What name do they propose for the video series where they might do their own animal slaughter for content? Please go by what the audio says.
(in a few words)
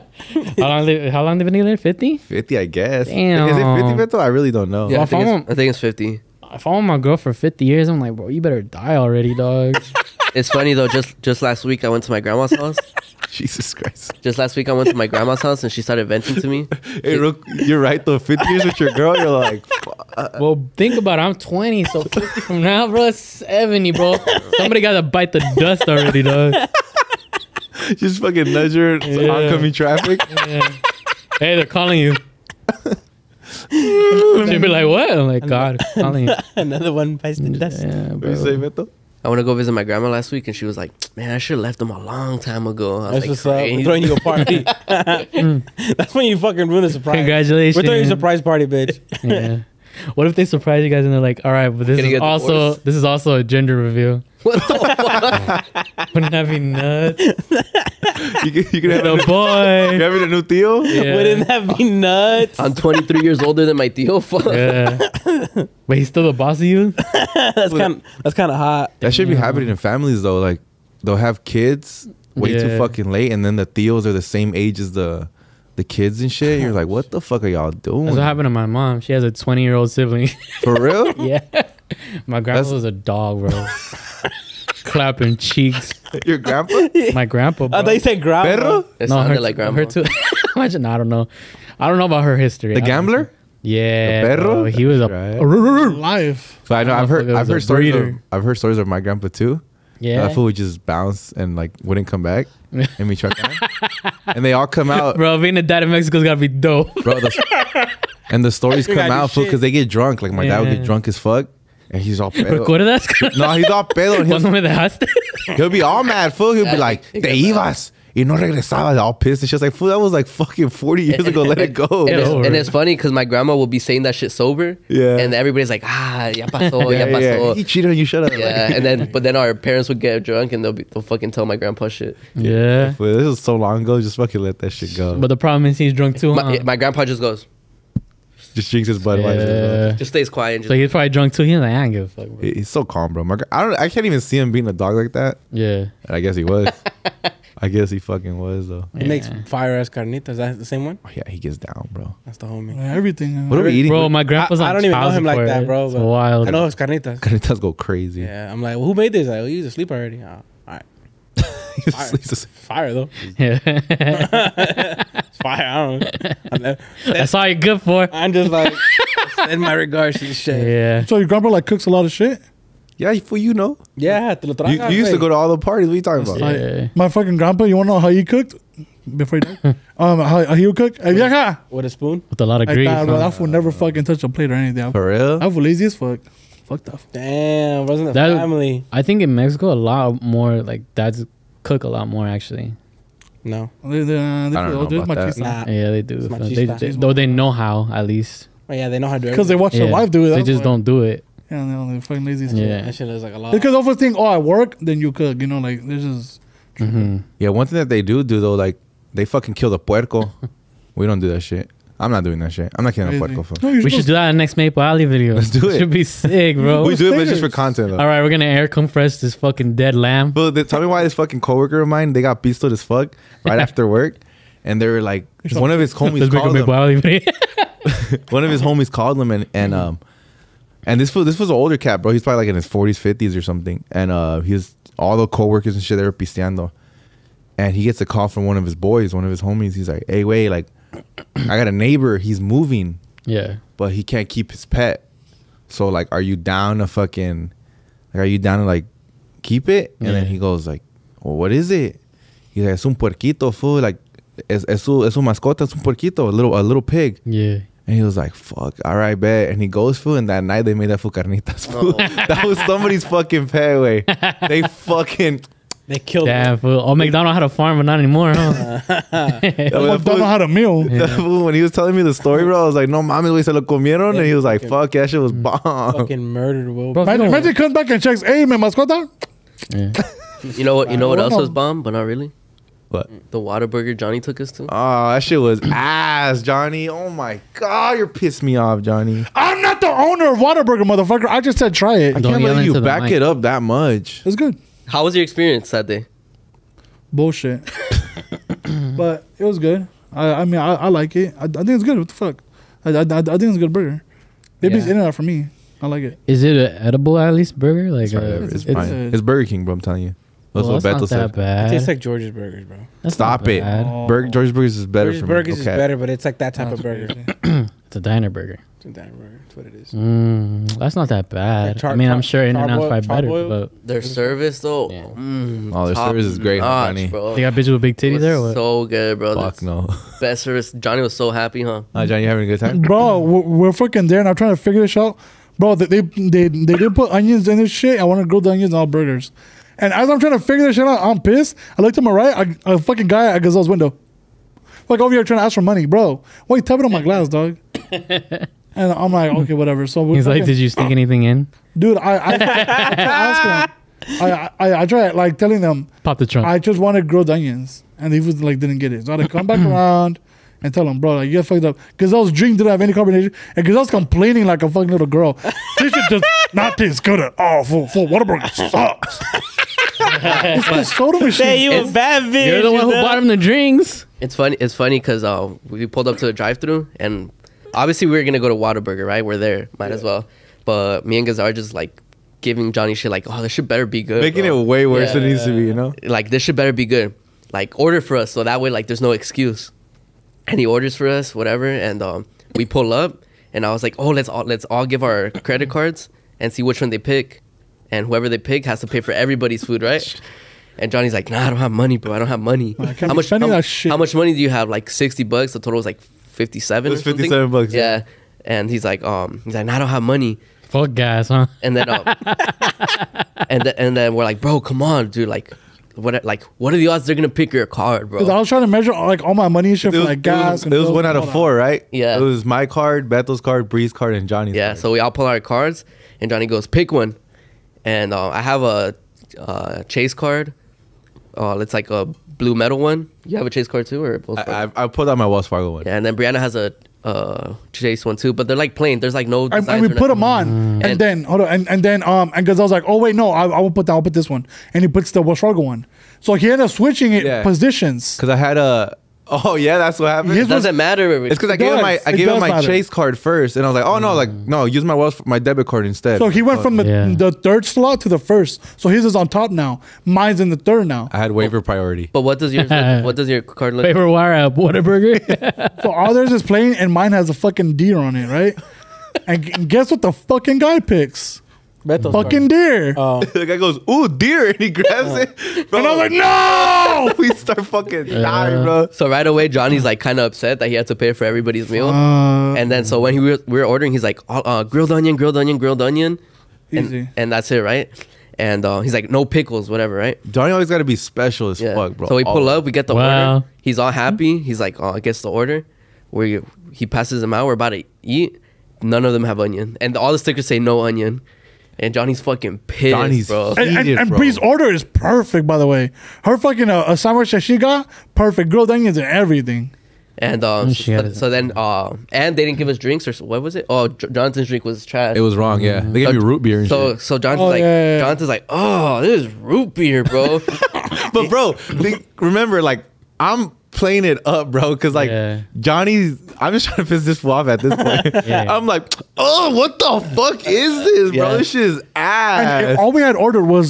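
Maple Alley.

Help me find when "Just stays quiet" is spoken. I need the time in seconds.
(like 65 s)
139 s.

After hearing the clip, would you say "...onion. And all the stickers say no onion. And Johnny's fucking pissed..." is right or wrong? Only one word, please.
right.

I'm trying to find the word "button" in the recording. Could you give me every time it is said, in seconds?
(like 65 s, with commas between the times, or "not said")
not said.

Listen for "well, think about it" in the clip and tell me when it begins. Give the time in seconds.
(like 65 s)
20 s.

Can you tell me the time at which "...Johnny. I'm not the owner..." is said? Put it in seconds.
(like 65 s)
288 s.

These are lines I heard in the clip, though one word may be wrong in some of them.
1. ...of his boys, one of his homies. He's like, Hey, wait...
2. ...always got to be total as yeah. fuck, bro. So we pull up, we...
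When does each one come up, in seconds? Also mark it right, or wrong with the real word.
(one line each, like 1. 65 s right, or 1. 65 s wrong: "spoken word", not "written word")
1. 238 s right
2. 490 s wrong: "special", not "total".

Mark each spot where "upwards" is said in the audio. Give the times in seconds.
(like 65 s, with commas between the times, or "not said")
not said.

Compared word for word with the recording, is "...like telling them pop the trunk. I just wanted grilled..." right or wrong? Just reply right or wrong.
right.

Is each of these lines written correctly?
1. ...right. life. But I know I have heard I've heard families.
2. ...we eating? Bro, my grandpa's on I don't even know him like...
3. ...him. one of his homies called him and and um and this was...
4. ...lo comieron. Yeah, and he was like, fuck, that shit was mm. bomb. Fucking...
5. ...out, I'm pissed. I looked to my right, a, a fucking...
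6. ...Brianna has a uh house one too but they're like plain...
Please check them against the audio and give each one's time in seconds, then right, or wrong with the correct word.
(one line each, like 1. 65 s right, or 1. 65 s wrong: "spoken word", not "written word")
1. 95 s wrong: "stories", not "families"
2. 153 s right
3. 226 s right
4. 273 s right
5. 340 s right
6. 436 s wrong: "chase", not "house".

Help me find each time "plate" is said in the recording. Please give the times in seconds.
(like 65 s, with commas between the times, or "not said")
184 s.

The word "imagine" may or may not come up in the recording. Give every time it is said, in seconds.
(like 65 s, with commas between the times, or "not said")
90 s, 277 s.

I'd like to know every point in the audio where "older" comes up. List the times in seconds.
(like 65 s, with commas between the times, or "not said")
63 s, 231 s.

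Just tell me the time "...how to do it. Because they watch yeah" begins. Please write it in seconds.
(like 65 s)
199 s.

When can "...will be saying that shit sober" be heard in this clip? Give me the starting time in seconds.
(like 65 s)
123 s.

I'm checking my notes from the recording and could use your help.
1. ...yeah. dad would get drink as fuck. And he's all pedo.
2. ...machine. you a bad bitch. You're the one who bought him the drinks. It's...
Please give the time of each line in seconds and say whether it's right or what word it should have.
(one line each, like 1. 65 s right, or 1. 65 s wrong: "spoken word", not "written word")
1. 110 s wrong: "drunk", not "drink"
2. 371 s right.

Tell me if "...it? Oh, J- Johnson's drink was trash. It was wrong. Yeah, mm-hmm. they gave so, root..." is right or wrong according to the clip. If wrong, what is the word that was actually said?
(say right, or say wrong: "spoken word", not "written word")
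right.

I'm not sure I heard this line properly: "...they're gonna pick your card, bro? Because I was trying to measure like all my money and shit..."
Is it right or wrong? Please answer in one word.
right.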